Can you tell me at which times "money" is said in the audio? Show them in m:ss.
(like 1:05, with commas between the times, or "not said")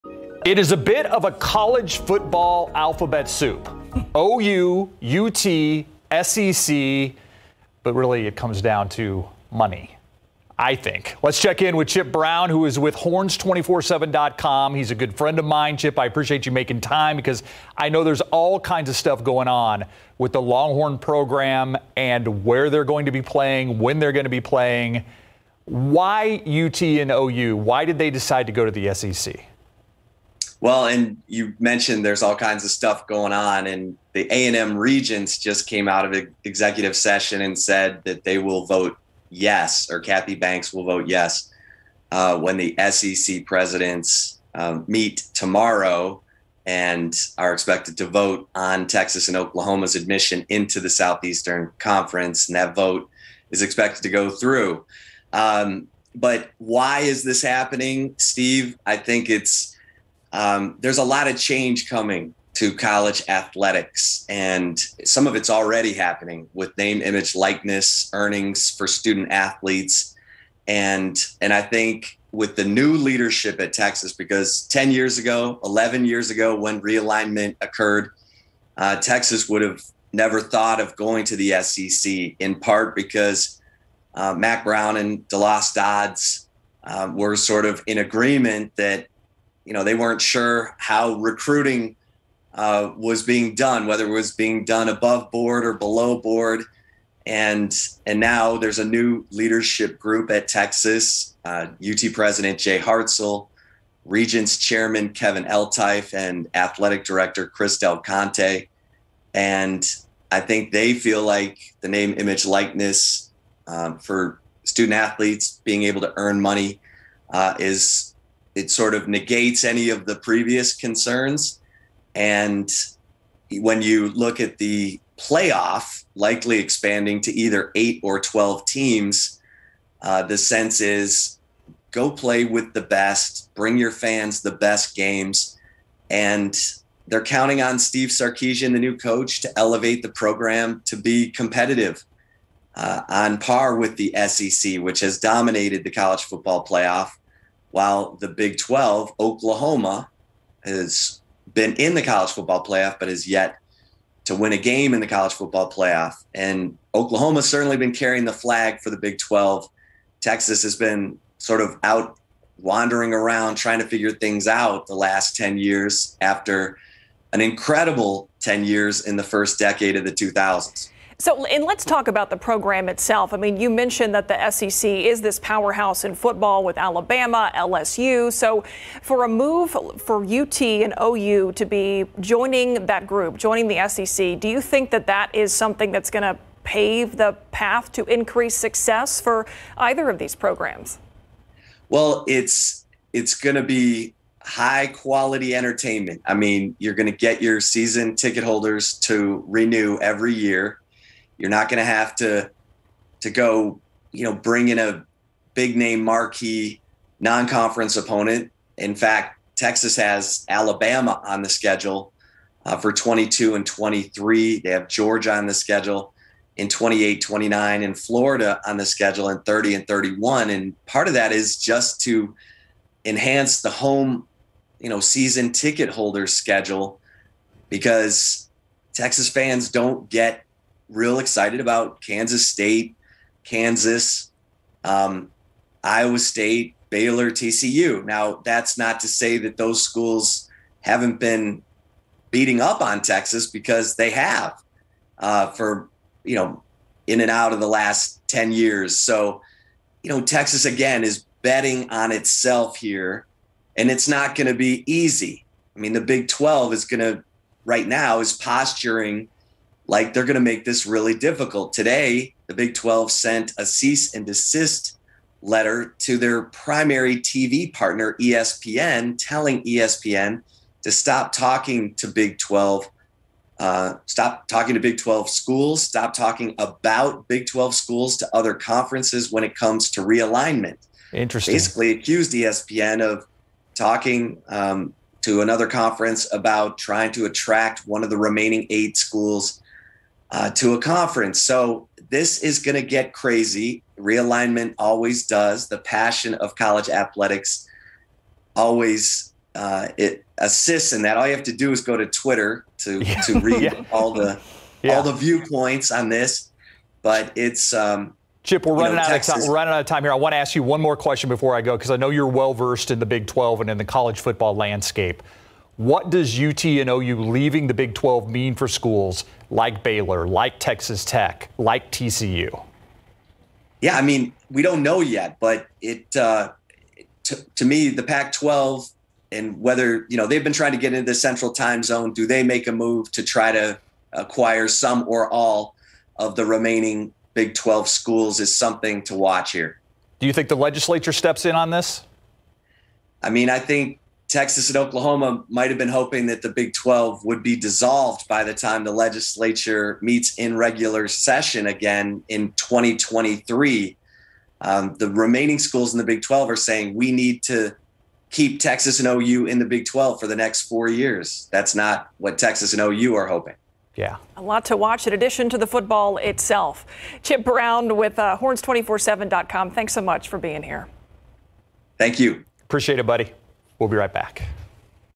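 0:09, 1:56.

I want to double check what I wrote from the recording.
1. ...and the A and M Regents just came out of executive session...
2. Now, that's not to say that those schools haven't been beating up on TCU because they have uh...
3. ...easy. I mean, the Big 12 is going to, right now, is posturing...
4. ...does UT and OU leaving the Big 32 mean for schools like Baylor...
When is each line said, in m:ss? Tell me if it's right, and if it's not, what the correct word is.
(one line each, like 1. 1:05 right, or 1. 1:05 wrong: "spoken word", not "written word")
1. 0:33 right
2. 3:58 wrong: "Texas", not "TCU"
3. 4:14 right
4. 5:16 wrong: "12", not "32".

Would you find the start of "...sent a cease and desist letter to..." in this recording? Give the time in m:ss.
4:23.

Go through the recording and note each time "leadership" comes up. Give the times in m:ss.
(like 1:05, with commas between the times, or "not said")
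1:12, 1:39.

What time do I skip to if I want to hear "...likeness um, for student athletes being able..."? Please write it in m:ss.
1:52.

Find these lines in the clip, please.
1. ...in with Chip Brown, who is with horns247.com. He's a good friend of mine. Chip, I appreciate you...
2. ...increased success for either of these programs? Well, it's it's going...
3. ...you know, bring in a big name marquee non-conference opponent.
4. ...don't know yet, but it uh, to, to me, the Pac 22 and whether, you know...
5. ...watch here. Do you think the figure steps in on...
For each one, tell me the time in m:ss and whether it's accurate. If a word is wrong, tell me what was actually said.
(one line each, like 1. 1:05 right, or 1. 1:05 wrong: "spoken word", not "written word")
1. 0:11 right
2. 3:08 right
3. 3:24 right
4. 5:24 wrong: "12", not "22"
5. 5:39 wrong: "legislature", not "figure".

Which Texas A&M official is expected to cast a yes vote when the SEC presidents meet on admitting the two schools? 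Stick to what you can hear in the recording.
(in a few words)
Kathy Banks.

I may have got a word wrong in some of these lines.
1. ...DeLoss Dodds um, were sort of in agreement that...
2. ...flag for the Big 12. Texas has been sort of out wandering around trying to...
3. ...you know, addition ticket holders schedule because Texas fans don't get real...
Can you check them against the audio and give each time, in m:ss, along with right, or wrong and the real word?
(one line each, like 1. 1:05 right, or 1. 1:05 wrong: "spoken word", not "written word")
1. 1:25 right
2. 2:38 right
3. 3:44 wrong: "season", not "addition".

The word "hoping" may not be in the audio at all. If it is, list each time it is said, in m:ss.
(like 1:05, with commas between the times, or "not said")
5:45, 6:03.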